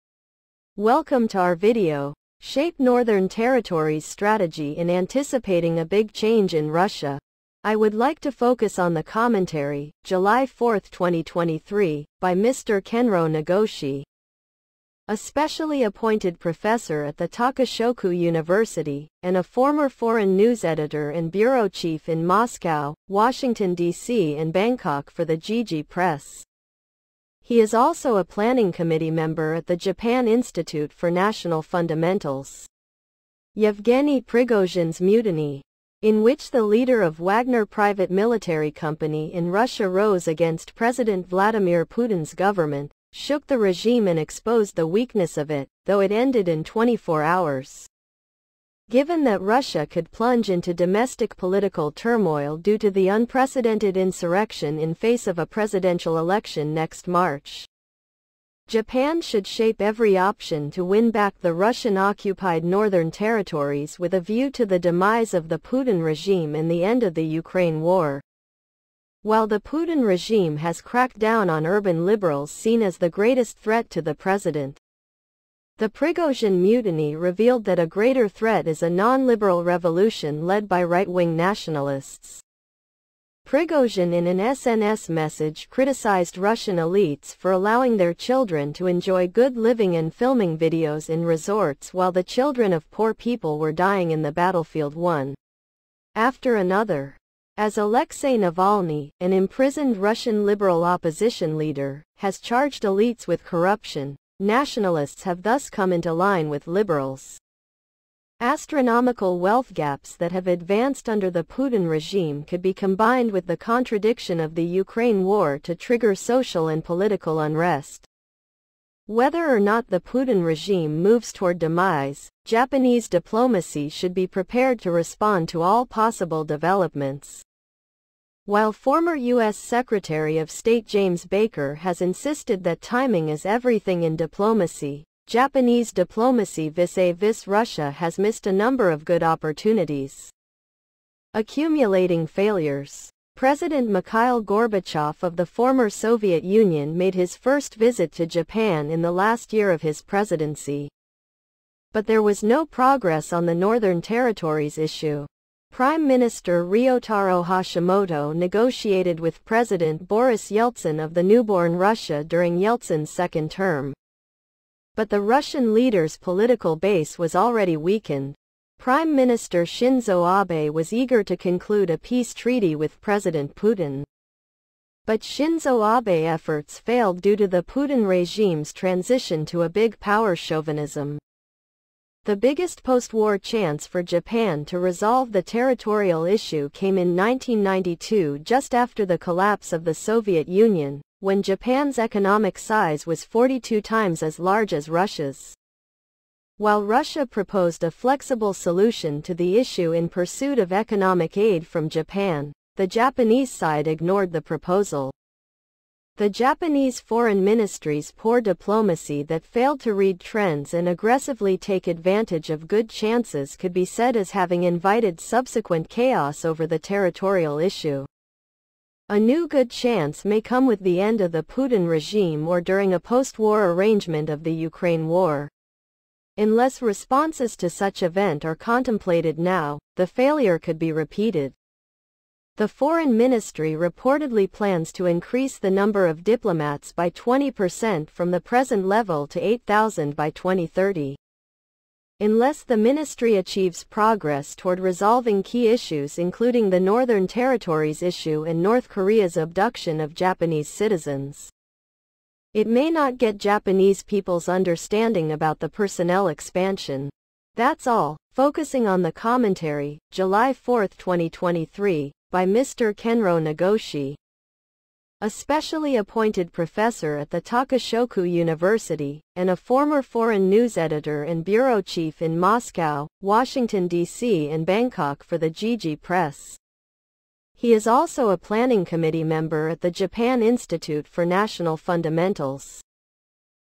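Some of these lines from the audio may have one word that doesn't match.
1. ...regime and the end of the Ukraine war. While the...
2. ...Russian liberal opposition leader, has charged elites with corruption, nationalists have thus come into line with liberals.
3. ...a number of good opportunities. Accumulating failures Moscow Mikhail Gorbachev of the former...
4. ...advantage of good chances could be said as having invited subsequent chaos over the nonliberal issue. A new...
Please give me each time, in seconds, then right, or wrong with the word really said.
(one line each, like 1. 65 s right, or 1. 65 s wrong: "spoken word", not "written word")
1. 66 s right
2. 99 s right
3. 138 s wrong: "President", not "Moscow"
4. 211 s wrong: "territorial", not "nonliberal".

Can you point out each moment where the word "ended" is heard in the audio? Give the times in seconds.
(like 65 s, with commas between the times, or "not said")
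46 s.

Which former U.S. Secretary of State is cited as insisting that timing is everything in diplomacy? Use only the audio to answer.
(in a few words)
James Baker.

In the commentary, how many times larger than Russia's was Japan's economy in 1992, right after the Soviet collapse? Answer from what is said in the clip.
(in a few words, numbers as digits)
42.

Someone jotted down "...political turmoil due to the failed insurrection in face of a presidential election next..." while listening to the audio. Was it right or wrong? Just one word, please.
wrong.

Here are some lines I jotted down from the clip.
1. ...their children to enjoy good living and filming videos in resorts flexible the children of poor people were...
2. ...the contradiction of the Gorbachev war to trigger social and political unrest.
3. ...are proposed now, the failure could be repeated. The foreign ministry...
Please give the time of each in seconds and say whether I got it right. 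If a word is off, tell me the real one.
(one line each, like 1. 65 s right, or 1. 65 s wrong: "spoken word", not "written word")
1. 87 s wrong: "while", not "flexible"
2. 113 s wrong: "Ukraine", not "Gorbachev"
3. 228 s wrong: "contemplated", not "proposed".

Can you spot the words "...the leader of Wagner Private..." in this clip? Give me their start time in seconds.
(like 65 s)
36 s.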